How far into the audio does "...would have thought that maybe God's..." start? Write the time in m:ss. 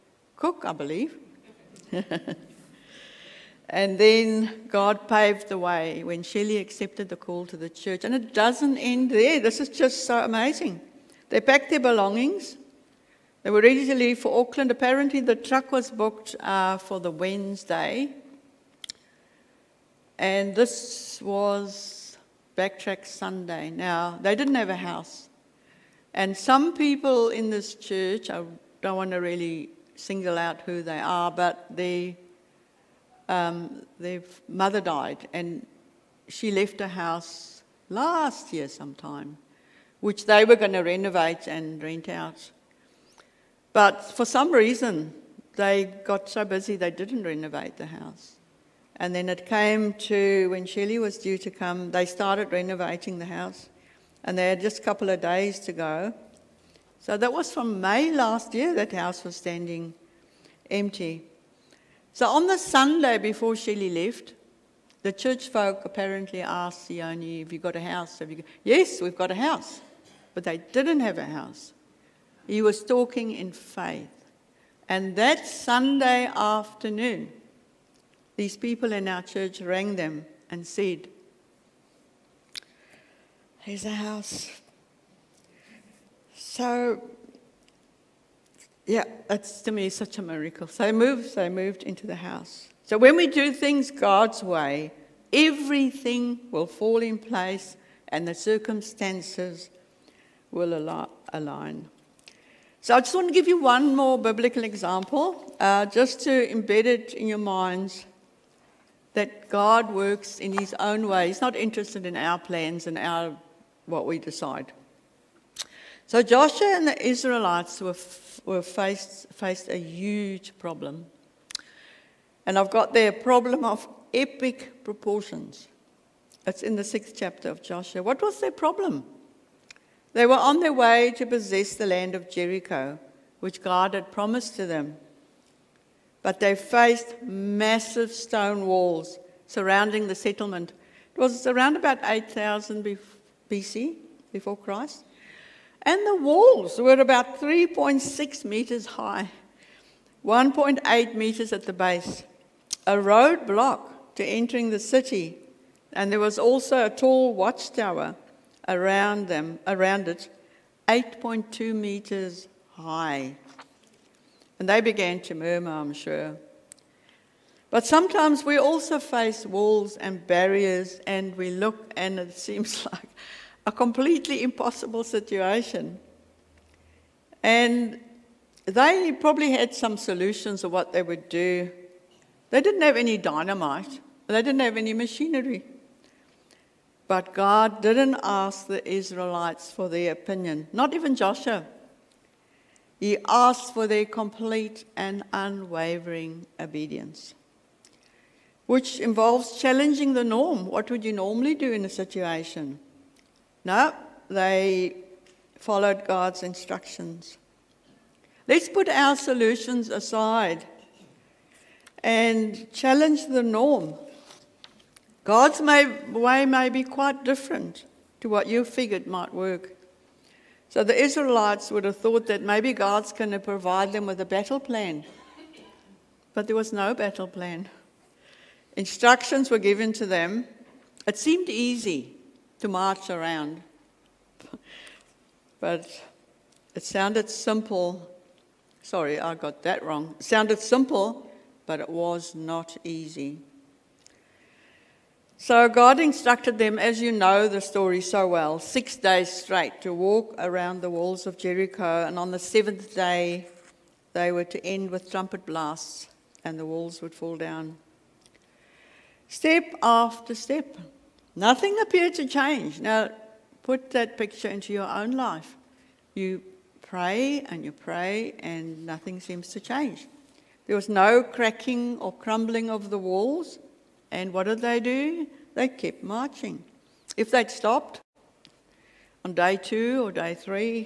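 3:41.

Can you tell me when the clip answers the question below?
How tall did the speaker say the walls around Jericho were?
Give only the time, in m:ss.
2:27.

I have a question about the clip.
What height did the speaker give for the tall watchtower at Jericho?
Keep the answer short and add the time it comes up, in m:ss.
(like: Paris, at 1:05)
8.2 meters, at 2:40.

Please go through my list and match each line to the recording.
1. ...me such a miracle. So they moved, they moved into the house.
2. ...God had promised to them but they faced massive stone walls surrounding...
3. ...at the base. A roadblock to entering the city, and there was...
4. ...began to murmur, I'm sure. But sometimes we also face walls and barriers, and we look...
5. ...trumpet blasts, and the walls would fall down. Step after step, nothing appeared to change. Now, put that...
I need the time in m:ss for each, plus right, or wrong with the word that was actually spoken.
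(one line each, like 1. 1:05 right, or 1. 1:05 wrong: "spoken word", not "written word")
1. 1:29 right
2. 2:13 right
3. 2:31 right
4. 2:44 right
5. 4:15 right.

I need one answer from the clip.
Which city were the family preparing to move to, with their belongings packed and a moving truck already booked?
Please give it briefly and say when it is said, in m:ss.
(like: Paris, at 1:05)
Auckland, at 0:14.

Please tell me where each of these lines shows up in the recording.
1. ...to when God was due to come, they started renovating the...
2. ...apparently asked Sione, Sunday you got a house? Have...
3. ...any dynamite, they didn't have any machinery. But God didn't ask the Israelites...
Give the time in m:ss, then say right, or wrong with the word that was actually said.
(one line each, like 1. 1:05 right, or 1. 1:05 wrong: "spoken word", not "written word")
1. 0:49 wrong: "Shelley", not "God"
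2. 1:05 wrong: "Have", not "Sunday"
3. 3:02 right.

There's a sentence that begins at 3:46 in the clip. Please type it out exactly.
But there was no battle plan.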